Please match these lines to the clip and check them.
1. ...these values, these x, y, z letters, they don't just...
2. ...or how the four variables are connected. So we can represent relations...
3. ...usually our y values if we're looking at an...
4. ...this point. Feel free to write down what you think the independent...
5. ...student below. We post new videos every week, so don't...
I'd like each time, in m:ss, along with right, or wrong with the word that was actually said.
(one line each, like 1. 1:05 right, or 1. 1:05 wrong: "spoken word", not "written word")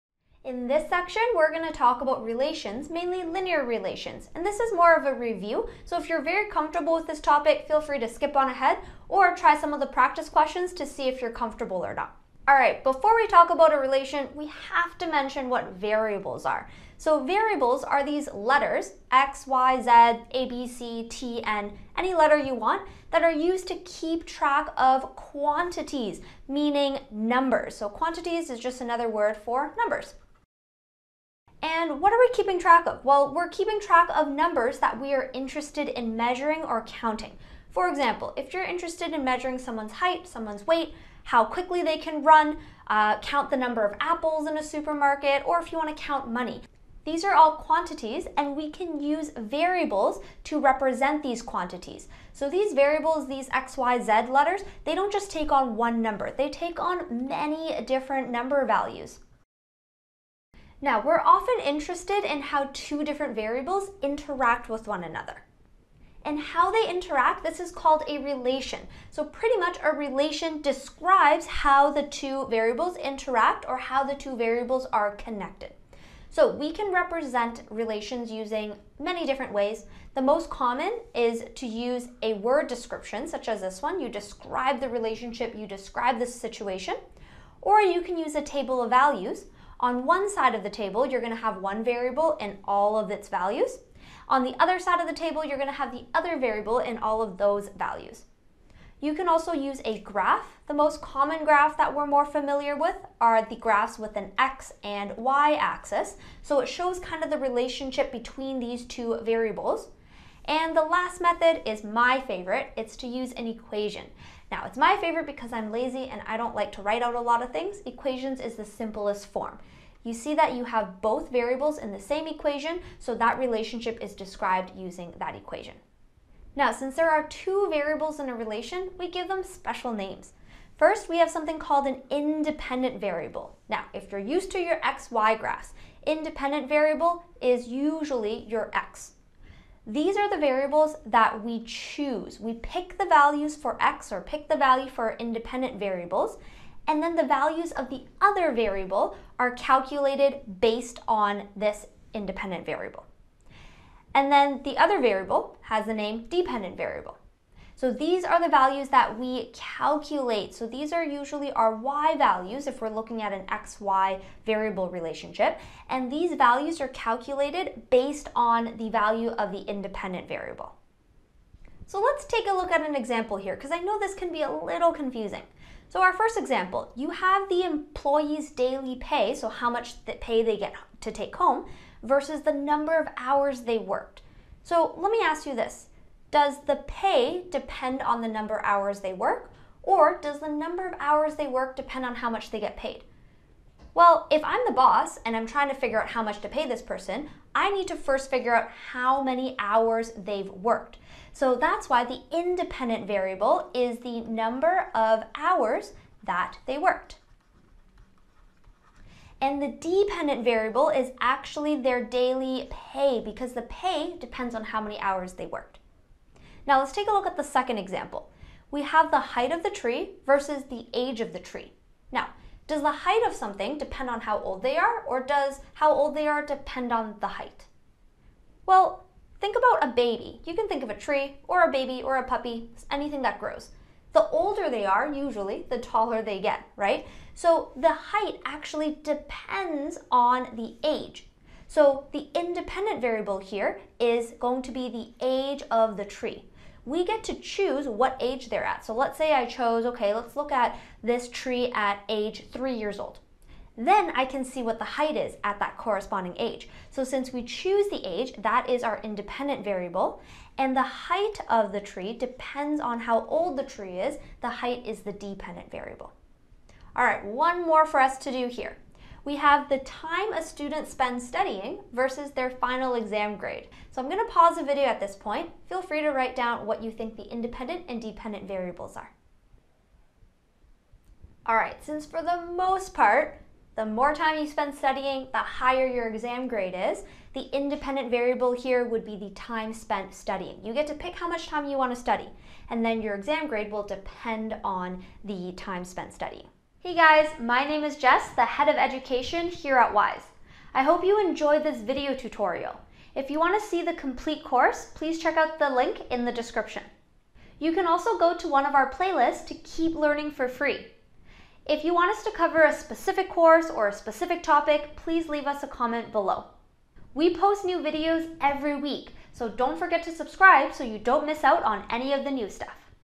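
1. 0:52 wrong: "variables", not "values"
2. 1:13 wrong: "two", not "four"
3. 2:41 right
4. 4:34 right
5. 5:15 wrong: "comment", not "student".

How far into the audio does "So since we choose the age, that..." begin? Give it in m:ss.
4:16.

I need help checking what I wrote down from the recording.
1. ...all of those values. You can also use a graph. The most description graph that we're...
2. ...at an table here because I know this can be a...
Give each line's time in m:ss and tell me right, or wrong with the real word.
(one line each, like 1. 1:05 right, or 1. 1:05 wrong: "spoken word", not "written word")
1. 1:36 wrong: "common", not "description"
2. 2:52 wrong: "example", not "table".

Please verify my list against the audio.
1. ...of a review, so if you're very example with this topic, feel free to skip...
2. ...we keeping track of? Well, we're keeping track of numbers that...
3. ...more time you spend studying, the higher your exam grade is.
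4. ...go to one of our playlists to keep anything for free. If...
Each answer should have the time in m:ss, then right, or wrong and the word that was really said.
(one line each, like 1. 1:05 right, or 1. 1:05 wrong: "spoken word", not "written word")
1. 0:04 wrong: "comfortable", not "example"
2. 0:32 right
3. 4:43 right
4. 5:08 wrong: "learning", not "anything".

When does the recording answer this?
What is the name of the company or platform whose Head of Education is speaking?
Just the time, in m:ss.
4:59.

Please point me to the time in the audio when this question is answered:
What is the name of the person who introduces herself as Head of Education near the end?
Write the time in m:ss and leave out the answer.
4:57.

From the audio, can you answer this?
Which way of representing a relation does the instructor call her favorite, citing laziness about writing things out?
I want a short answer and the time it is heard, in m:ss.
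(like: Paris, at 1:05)
An equation, at 1:53.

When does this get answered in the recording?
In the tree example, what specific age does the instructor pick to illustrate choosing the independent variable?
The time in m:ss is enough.
4:12.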